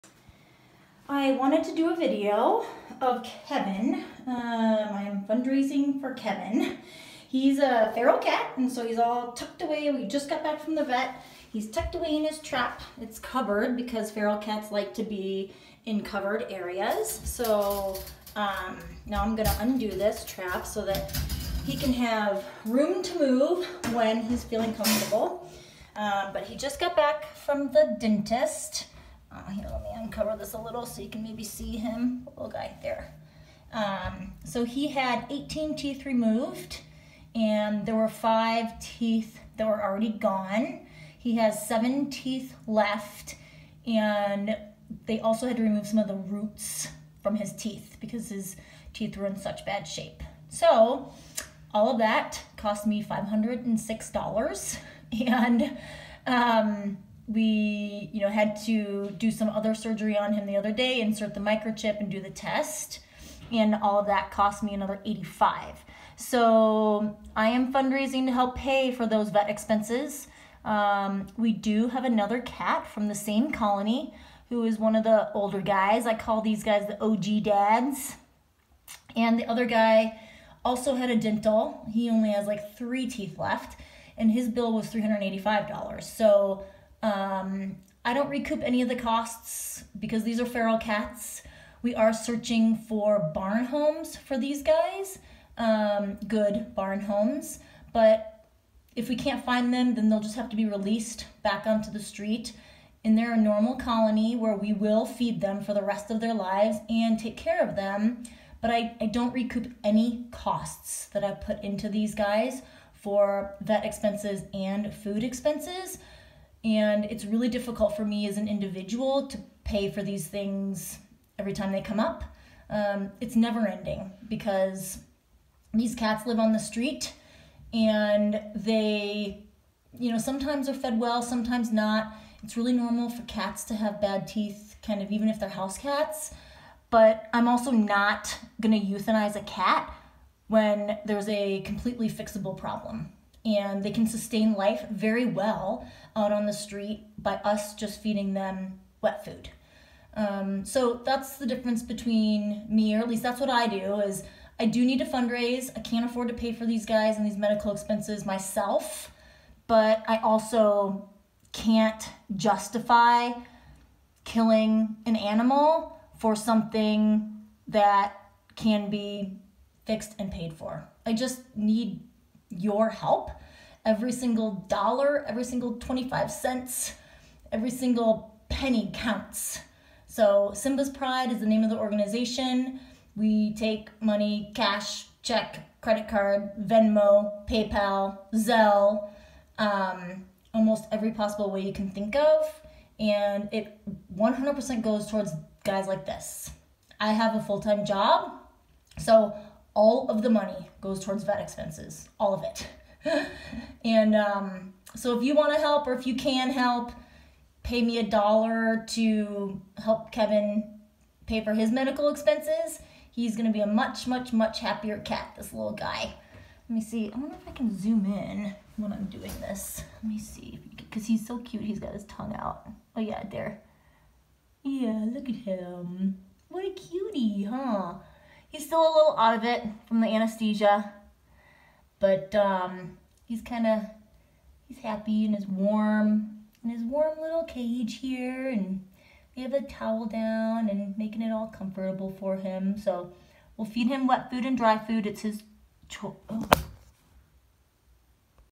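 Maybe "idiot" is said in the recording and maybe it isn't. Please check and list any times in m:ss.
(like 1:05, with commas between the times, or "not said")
not said.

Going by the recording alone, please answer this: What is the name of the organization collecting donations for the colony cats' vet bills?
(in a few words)
Simba's Pride.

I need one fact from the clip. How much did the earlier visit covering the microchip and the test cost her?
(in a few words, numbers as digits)
$85.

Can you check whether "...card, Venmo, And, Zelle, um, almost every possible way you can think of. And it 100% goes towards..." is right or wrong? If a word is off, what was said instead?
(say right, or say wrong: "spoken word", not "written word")
wrong: "PayPal", not "And".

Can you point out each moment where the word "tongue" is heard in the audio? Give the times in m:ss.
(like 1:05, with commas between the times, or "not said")
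3:42.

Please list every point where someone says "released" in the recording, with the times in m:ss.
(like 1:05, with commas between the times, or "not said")
1:40.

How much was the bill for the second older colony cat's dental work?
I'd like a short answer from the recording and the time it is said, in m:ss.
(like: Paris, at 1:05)
$385, at 1:24.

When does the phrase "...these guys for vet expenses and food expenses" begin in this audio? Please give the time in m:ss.
1:51.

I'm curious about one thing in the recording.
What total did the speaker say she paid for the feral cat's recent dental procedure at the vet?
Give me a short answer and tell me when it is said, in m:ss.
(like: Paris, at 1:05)
$506, at 0:53.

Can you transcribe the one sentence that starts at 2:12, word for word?
It's really normal for cats to have bad teeth, kind of even if they're house cats.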